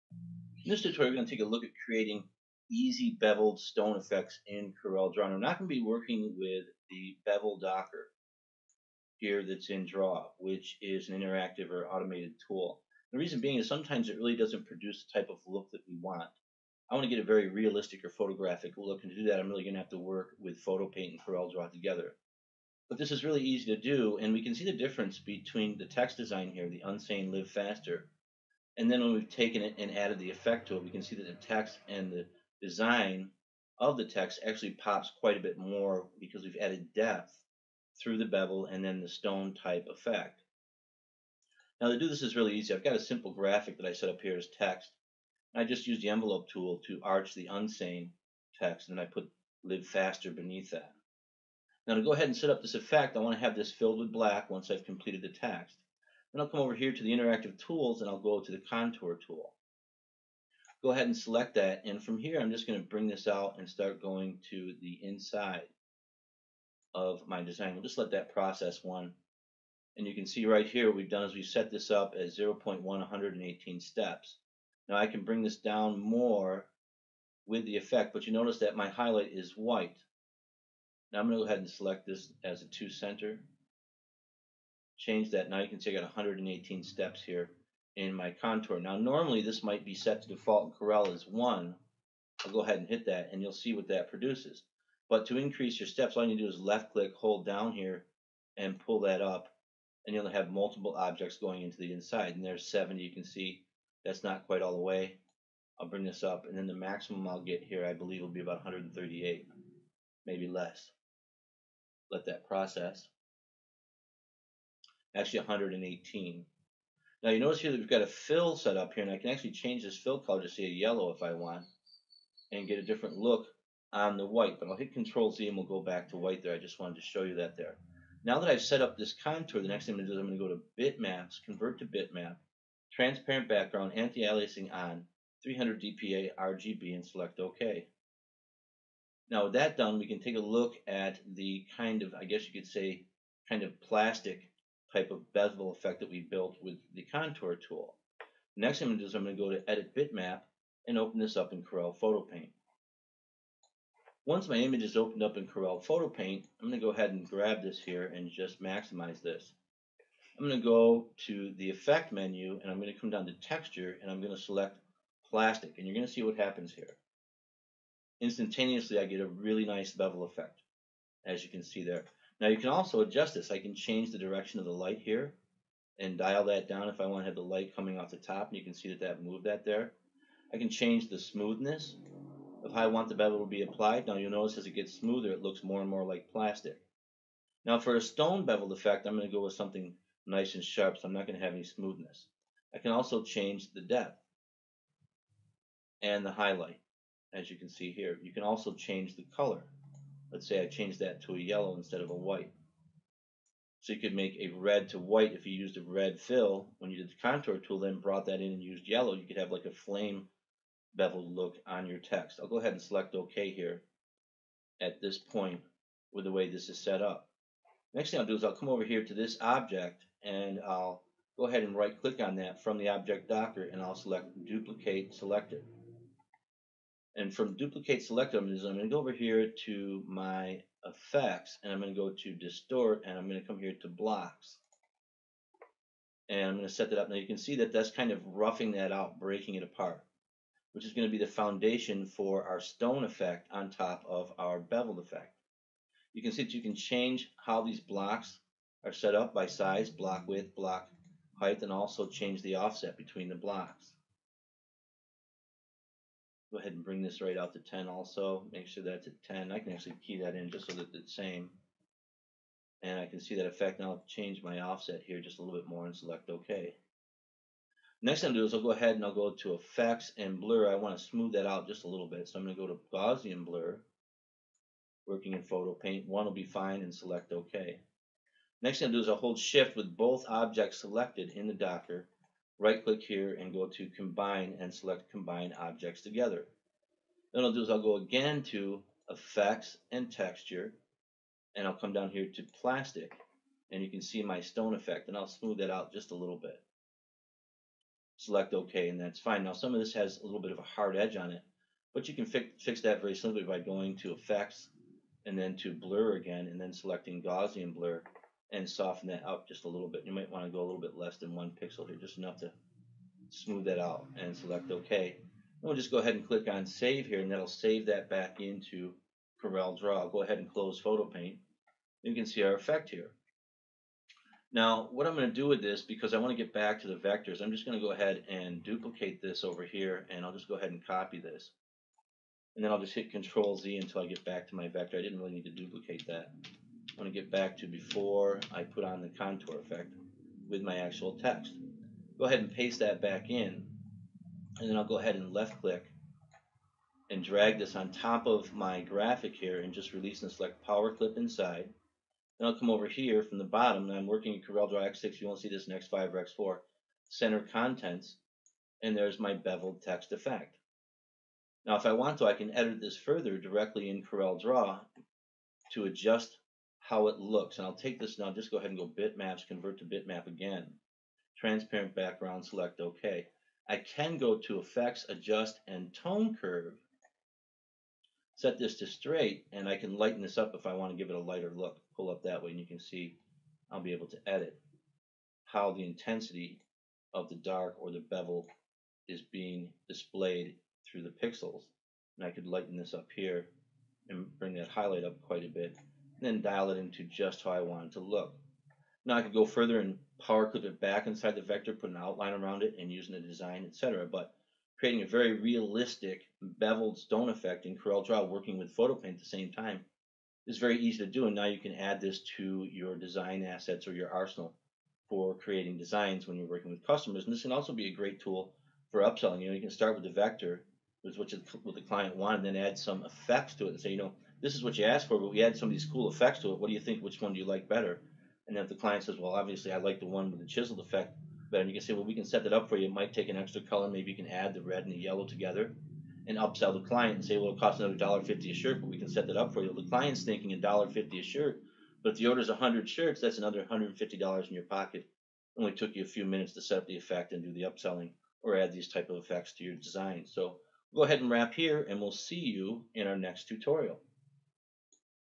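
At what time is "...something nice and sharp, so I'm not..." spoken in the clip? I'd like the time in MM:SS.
03:09.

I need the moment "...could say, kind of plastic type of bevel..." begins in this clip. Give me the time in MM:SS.
02:22.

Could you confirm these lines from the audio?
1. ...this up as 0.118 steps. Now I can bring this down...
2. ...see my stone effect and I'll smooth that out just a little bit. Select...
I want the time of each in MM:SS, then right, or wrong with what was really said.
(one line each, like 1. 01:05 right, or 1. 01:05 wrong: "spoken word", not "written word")
1. 01:11 right
2. 04:54 right.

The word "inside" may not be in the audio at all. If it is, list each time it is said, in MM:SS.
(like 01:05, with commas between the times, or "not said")
01:05, 01:41, 05:51, 06:41.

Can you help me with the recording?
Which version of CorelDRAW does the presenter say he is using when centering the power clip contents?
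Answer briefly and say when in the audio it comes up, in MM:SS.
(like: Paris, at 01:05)
CorelDRAW X6, at 05:54.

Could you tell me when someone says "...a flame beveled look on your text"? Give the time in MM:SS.
03:29.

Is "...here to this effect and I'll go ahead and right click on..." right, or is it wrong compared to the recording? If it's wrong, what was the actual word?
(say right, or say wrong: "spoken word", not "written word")
wrong: "object", not "effect".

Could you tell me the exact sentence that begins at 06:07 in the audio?
And I'll take this now, just go ahead and go bitmaps, convert to bitmap again.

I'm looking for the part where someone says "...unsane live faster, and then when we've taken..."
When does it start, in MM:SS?
00:26.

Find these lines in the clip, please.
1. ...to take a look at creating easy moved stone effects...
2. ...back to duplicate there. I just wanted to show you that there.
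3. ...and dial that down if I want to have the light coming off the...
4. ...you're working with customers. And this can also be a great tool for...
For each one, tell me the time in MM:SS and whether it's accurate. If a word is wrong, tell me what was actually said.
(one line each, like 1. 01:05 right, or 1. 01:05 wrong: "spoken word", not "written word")
1. 00:01 wrong: "beveled", not "moved"
2. 02:05 wrong: "white", not "duplicate"
3. 02:55 right
4. 06:56 right.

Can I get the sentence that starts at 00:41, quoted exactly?
Now to do this is really easy.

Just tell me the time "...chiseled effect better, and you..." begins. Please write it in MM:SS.
07:10.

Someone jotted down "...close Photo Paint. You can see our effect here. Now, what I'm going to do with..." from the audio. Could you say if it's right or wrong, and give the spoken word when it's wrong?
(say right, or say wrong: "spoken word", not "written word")
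right.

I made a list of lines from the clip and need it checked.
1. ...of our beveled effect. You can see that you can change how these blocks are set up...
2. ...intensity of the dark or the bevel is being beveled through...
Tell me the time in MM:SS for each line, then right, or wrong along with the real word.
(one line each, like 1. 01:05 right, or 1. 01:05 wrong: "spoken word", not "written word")
1. 04:04 right
2. 06:25 wrong: "displayed", not "beveled".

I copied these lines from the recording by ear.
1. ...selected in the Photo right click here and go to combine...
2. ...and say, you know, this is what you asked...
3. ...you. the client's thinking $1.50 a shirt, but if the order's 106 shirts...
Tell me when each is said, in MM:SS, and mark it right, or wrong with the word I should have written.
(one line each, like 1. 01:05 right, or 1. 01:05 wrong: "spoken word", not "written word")
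1. 04:40 wrong: "Docker", not "Photo"
2. 07:03 right
3. 07:19 wrong: "100", not "106".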